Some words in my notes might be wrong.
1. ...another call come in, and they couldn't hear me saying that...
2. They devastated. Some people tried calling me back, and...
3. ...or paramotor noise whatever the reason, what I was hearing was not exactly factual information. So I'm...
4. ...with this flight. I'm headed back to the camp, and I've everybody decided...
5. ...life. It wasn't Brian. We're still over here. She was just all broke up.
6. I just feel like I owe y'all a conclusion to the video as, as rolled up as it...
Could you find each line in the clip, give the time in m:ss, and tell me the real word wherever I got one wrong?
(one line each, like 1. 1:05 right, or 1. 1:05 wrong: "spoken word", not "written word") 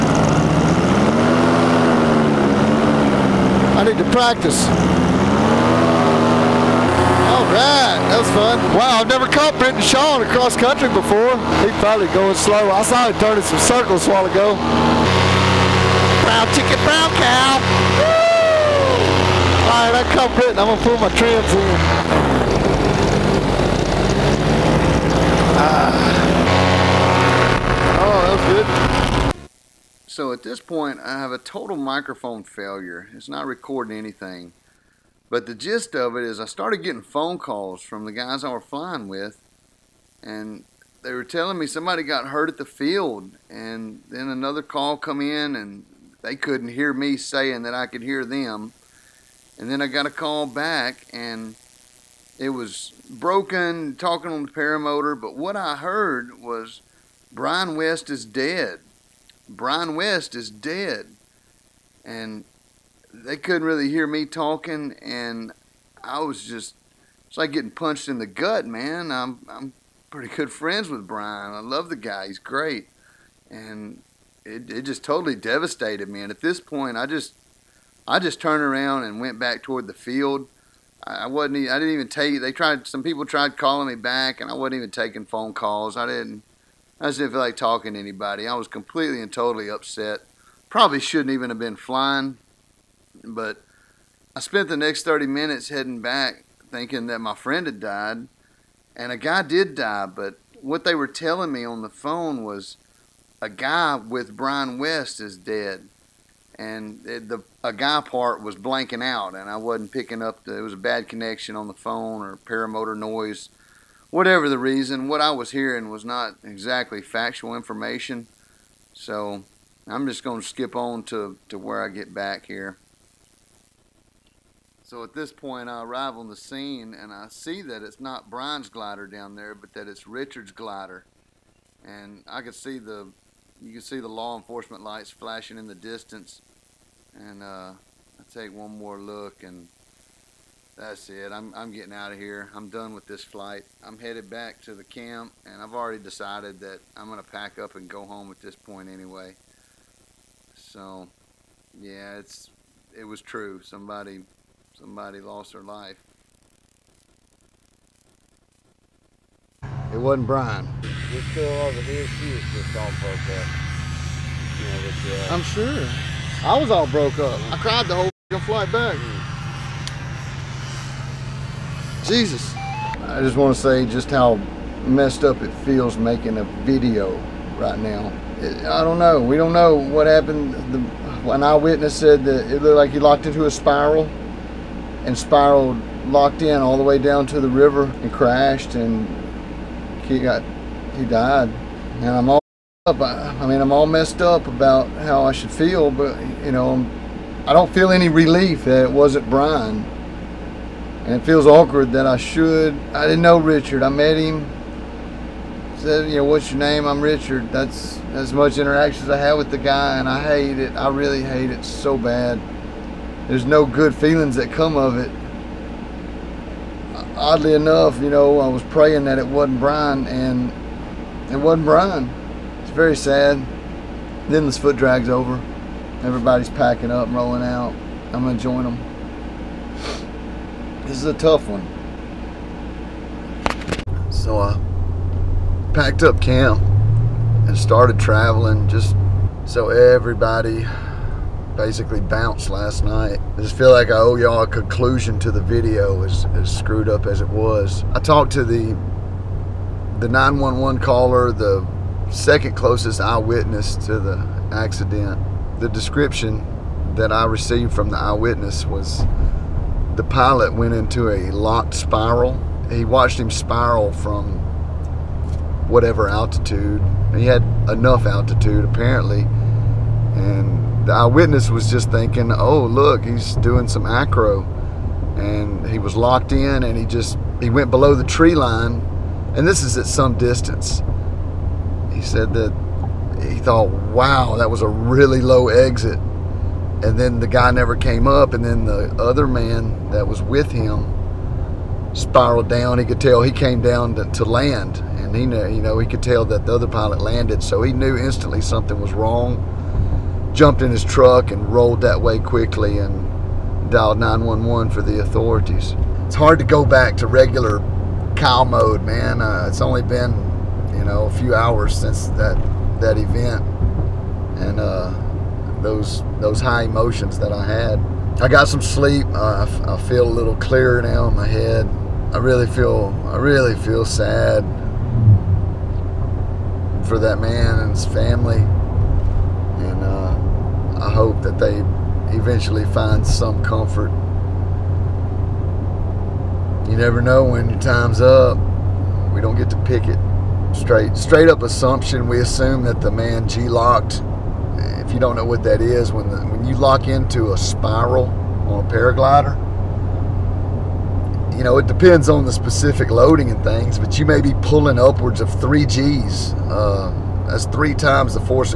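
1. 0:44 right
2. 1:22 wrong: "tried", not "devastated"
3. 1:52 right
4. 2:22 wrong: "already", not "everybody"
5. 2:35 right
6. 4:03 wrong: "screwed", not "rolled".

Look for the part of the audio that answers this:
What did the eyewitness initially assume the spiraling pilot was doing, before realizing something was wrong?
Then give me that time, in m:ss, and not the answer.
4:33.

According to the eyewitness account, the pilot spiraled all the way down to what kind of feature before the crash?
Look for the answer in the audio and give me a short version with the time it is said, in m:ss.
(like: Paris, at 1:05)
the river, at 3:07.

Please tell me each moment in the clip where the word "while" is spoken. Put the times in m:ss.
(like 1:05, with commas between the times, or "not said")
0:14.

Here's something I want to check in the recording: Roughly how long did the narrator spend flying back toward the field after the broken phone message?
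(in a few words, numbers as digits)
30 minutes.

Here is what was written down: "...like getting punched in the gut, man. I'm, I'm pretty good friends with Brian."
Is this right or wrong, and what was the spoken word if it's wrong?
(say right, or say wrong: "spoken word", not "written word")
right.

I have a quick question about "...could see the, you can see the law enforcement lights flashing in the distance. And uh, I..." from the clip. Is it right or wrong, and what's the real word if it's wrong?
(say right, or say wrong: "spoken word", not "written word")
right.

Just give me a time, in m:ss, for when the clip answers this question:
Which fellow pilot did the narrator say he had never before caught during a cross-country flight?
0:09.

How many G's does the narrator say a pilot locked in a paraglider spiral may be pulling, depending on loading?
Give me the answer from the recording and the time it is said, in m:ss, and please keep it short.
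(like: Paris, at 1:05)
3, at 5:55.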